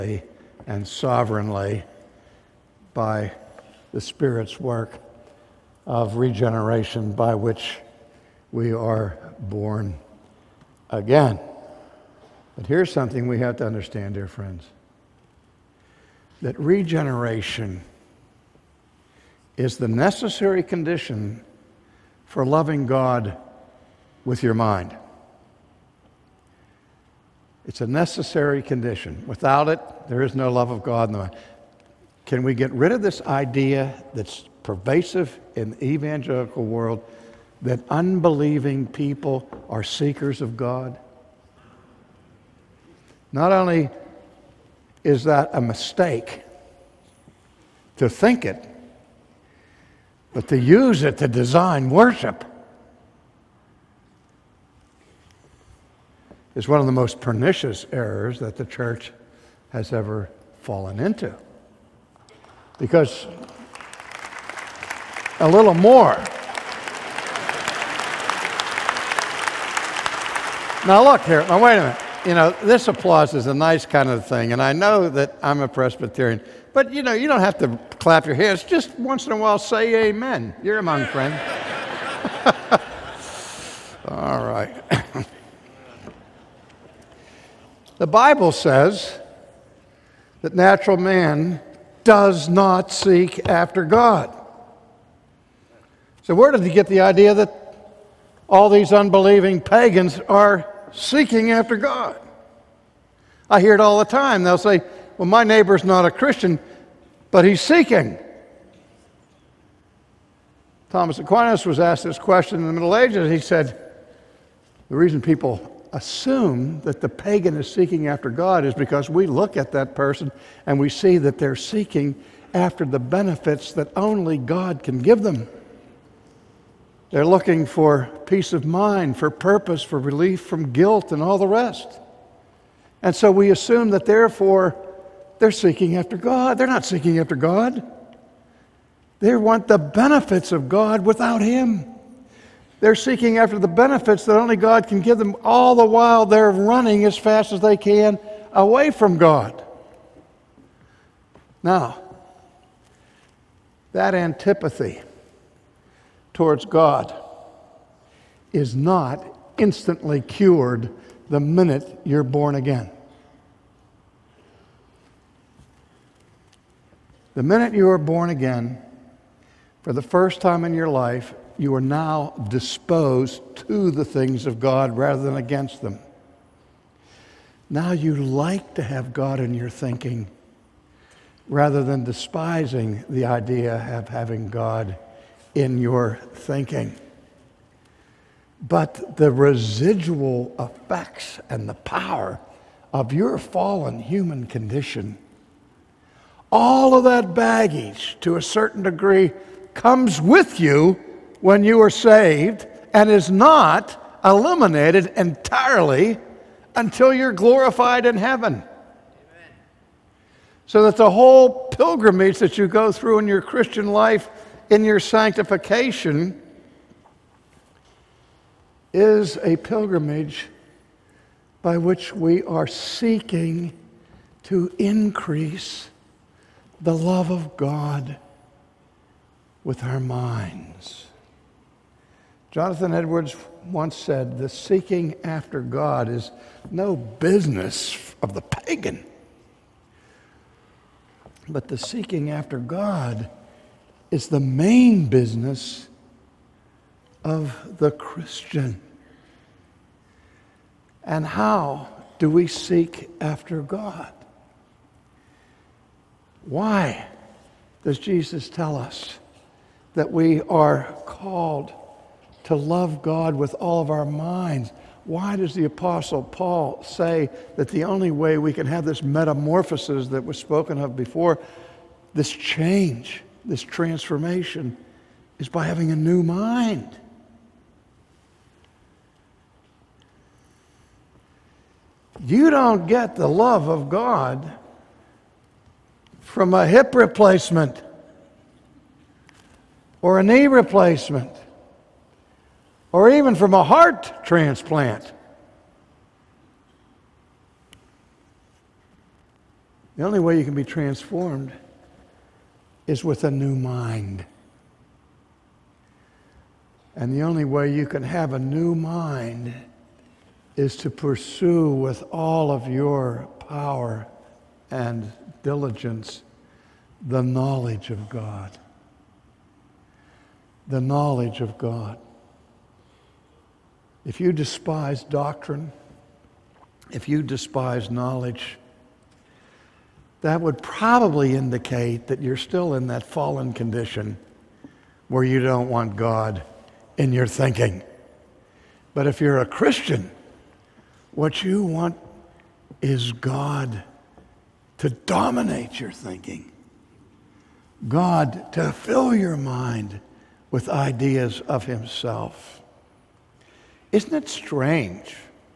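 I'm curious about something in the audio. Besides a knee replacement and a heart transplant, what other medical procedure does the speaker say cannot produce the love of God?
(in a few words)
Hip replacement.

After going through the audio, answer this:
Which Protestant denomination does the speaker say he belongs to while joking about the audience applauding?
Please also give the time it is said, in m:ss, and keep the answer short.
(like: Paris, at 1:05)
Presbyterian, at 1:15.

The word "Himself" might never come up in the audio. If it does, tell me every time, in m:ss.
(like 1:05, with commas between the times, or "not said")
5:51.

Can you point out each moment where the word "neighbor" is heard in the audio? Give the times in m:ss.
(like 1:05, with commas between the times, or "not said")
1:45.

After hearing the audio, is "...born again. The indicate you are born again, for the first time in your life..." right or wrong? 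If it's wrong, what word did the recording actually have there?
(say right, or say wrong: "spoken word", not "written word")
wrong: "minute", not "indicate".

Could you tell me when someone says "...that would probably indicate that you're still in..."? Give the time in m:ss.
5:30.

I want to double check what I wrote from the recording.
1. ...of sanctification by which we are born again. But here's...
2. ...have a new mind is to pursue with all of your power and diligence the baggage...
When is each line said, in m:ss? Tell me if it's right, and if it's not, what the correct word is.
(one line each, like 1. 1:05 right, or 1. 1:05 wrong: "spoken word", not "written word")
1. 0:05 wrong: "regeneration", not "sanctification"
2. 5:08 wrong: "knowledge", not "baggage".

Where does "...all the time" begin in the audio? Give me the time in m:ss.
1:43.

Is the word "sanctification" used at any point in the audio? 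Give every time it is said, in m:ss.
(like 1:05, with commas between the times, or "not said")
3:34.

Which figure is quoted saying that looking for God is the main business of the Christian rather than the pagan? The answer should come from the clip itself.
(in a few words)
Jonathan Edwards.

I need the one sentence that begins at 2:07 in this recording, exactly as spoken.
They're looking for peace of mind, for purpose, for relief from guilt, and all the rest.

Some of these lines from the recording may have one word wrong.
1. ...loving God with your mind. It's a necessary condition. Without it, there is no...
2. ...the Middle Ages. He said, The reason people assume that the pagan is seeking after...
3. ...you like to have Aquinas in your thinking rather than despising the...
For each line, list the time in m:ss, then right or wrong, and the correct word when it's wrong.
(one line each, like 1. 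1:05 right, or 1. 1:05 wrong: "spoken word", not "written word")
1. 0:22 right
2. 1:52 right
3. 2:57 wrong: "God", not "Aquinas".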